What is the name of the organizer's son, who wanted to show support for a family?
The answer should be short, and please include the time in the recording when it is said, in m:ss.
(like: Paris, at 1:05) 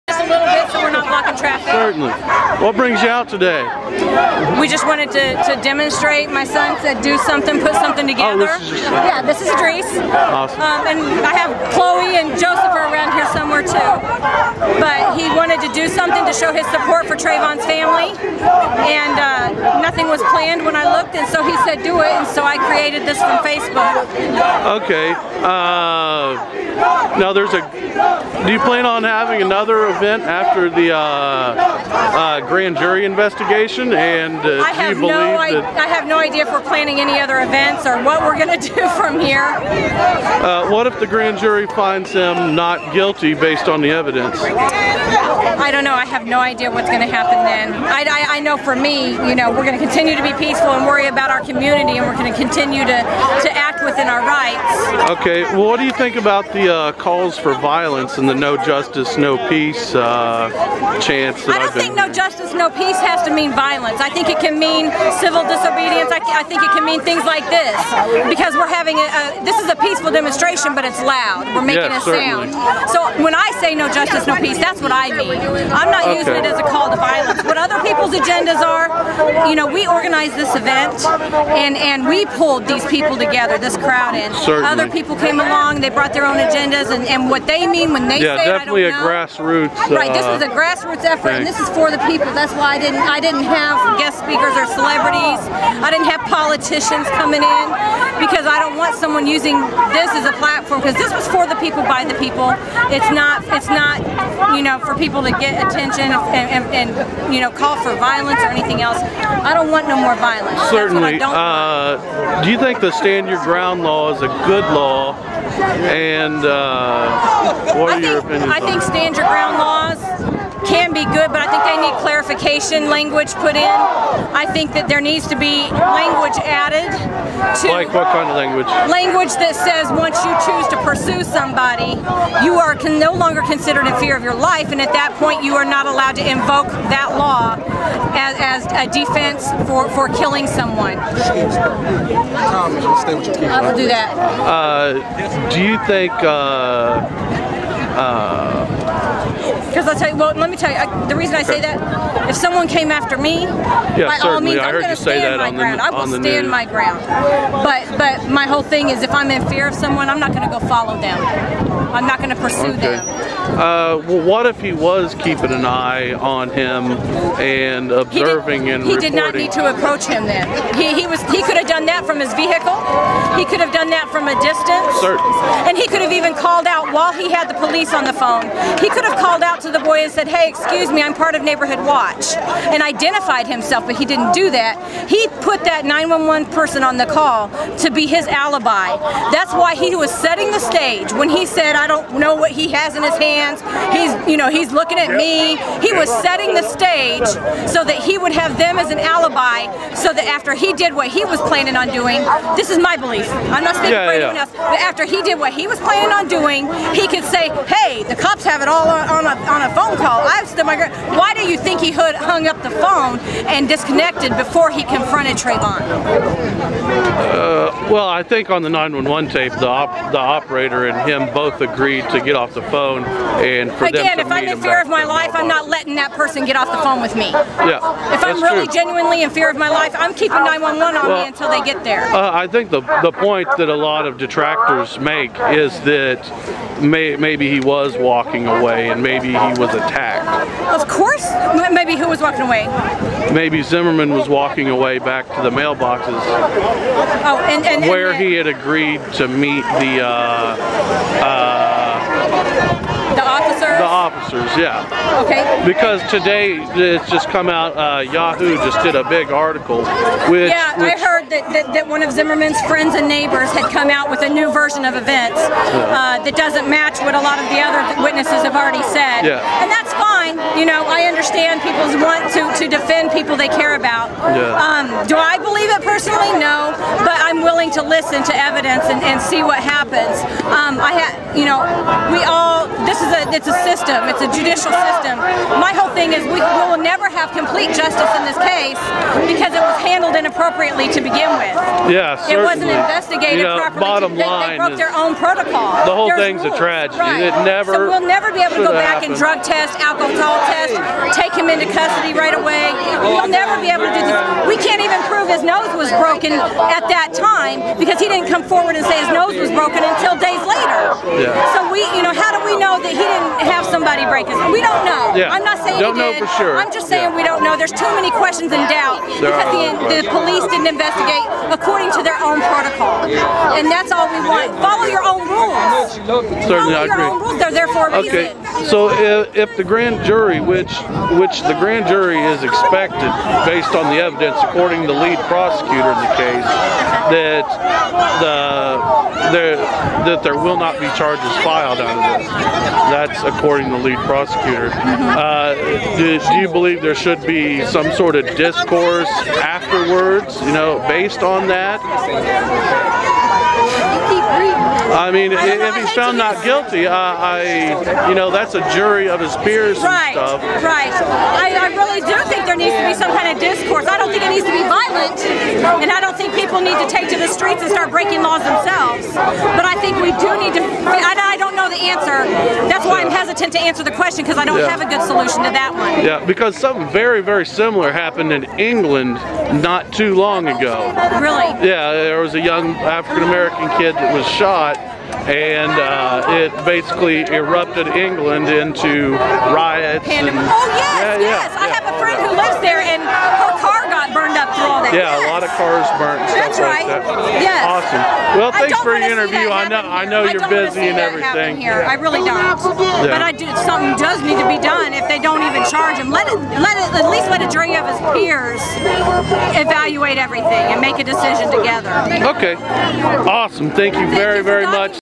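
Idris, at 0:09.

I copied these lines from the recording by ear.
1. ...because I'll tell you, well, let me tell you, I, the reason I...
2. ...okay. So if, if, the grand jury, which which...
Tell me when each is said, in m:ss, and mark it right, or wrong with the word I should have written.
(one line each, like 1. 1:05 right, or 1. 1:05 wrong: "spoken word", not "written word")
1. 2:29 right
2. 5:28 right.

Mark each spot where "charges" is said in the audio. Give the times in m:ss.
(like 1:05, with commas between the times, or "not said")
5:40, 6:45.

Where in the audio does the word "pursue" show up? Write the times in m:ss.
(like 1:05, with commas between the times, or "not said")
2:10, 2:42.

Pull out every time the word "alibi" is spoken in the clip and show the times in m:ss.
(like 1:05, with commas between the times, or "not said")
3:08, 3:18.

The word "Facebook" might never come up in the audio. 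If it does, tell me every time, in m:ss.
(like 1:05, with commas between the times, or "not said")
0:23.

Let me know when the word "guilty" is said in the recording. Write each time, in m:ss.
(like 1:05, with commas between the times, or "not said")
0:42, 5:56.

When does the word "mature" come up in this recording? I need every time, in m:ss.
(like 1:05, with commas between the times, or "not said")
not said.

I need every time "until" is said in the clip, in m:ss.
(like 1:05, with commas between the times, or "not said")
3:51, 5:09.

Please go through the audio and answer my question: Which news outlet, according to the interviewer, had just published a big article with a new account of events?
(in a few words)
Yahoo.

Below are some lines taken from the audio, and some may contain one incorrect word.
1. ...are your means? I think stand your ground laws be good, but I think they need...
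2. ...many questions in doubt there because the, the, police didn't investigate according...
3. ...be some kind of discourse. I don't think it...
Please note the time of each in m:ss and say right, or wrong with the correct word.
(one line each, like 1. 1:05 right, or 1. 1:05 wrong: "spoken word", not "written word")
1. 1:57 wrong: "opinions", not "means"
2. 5:17 right
3. 6:02 right.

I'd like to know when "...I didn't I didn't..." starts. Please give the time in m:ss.
1:32.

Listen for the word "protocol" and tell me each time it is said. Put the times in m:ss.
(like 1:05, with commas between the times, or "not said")
4:55, 5:22.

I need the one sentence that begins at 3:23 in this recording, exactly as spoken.
I'm not speaking yeah, for yeah.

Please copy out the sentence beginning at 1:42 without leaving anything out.
It's not it's not you know for people to get attention and, and, and you know call for violence or anything else.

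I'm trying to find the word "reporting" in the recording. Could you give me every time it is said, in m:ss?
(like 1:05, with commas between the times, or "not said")
2:48.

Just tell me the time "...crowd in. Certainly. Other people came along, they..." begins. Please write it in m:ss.
1:23.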